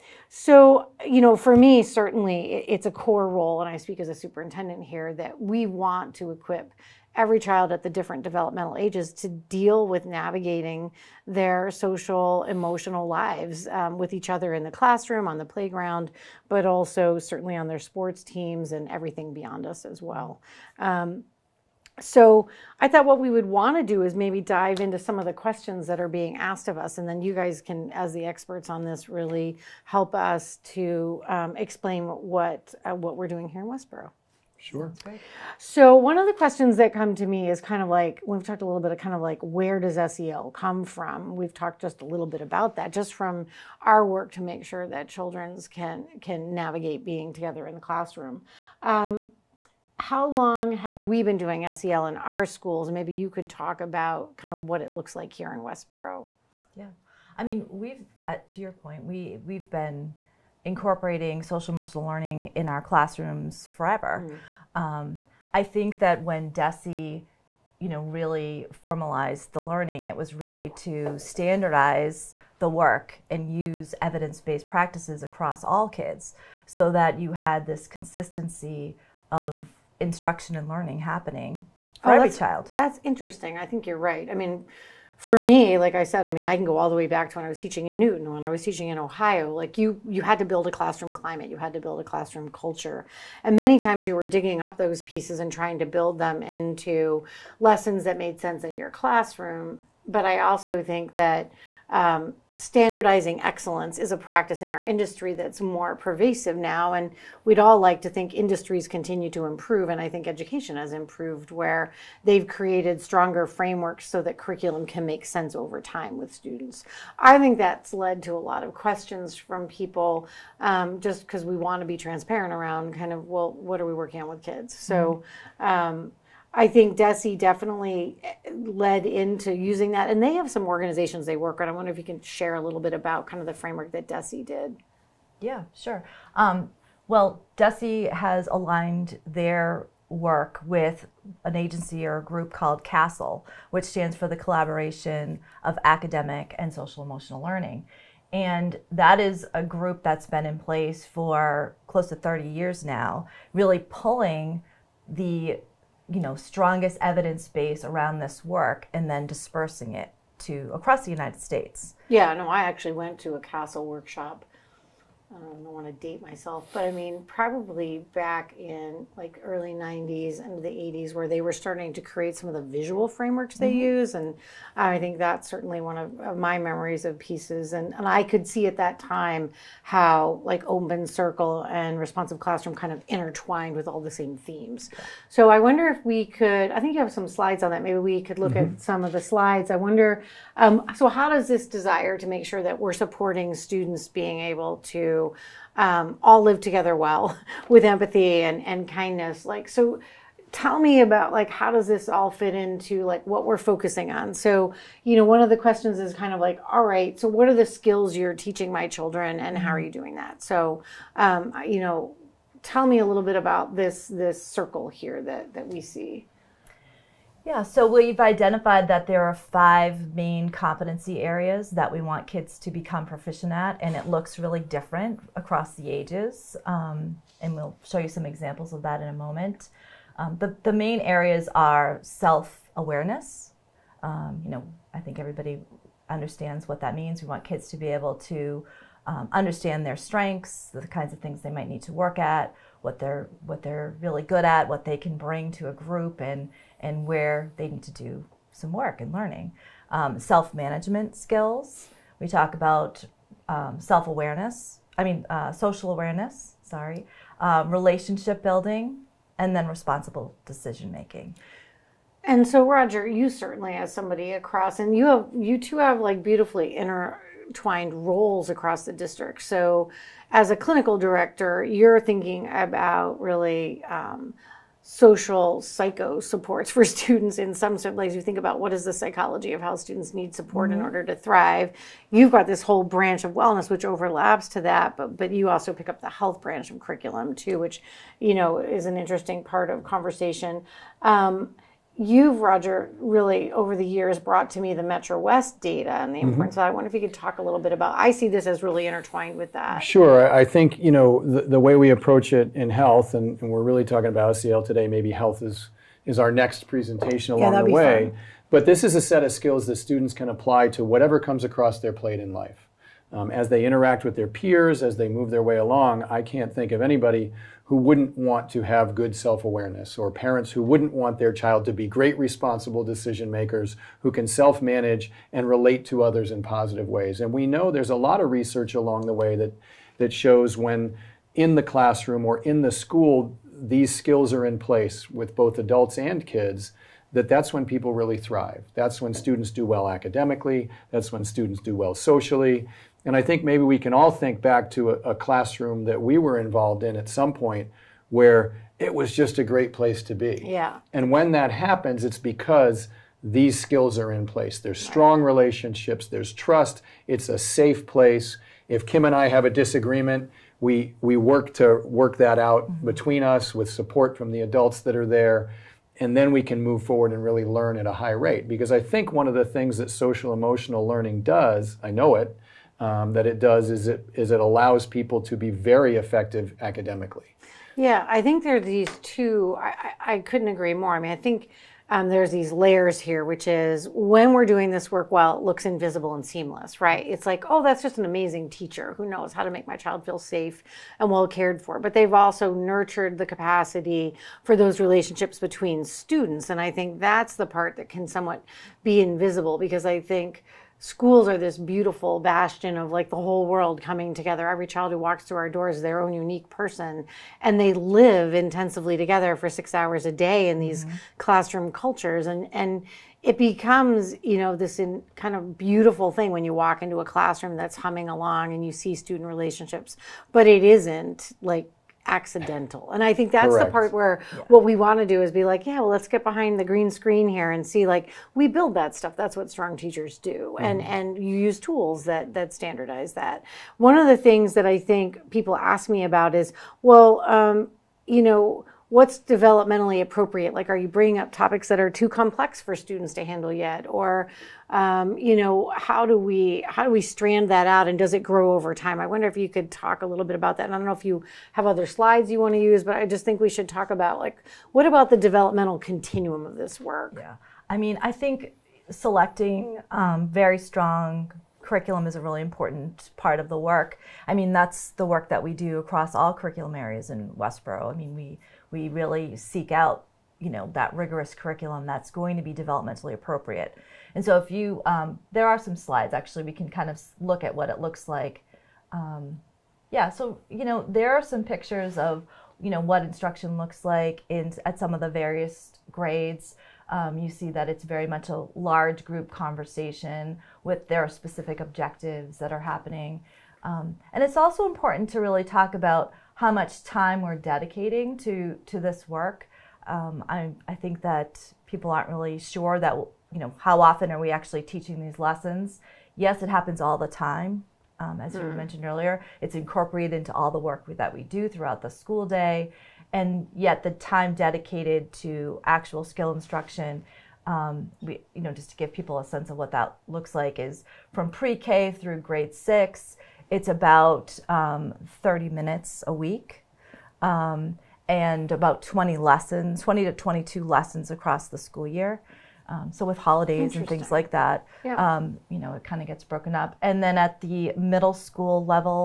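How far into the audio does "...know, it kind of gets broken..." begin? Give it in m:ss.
8:55.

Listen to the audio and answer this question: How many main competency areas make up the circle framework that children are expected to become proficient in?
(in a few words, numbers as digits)
5.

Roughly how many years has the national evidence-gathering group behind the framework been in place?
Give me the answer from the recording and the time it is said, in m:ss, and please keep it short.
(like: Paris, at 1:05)
close to 30 years, at 2:31.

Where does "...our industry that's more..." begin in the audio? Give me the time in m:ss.
1:44.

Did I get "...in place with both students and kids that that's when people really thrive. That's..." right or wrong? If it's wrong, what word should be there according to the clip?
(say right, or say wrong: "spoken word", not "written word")
wrong: "adults", not "students".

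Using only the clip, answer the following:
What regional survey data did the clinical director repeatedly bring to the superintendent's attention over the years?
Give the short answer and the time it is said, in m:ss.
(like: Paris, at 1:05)
Metro West data, at 4:54.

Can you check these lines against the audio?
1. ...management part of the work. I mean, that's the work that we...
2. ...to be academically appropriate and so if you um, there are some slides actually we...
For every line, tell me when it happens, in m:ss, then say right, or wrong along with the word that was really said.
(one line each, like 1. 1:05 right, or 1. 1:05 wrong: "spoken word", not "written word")
1. 7:42 wrong: "important", not "management"
2. 7:52 wrong: "developmentally", not "academically".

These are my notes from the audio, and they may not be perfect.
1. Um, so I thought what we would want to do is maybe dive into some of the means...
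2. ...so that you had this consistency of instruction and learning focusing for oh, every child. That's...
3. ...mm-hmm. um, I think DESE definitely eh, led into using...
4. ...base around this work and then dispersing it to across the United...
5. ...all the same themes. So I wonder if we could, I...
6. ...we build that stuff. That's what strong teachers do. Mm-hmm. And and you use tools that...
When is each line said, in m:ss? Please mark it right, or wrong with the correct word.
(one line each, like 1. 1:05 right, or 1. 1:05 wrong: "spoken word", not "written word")
1. 0:20 wrong: "questions", not "means"
2. 1:16 wrong: "happening", not "focusing"
3. 2:05 right
4. 2:37 right
5. 3:03 right
6. 7:08 right.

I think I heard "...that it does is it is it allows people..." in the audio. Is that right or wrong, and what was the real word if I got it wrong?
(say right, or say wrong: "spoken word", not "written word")
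right.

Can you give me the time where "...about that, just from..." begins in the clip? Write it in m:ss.
0:42.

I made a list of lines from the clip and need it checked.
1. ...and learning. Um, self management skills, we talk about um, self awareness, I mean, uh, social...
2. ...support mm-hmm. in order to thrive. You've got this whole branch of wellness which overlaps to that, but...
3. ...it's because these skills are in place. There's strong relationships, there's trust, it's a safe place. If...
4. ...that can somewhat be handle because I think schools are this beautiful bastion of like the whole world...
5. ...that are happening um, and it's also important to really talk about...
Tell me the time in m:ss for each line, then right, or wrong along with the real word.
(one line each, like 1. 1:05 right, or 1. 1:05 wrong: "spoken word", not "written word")
1. 4:09 right
2. 4:40 right
3. 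5:52 right
4. 6:37 wrong: "invisible", not "handle"
5. 8:12 right.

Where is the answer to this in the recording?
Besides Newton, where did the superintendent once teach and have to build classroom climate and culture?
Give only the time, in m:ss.
1:28.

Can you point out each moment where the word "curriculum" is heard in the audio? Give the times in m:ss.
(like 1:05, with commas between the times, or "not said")
1:54, 4:46, 7:41, 7:46, 7:51.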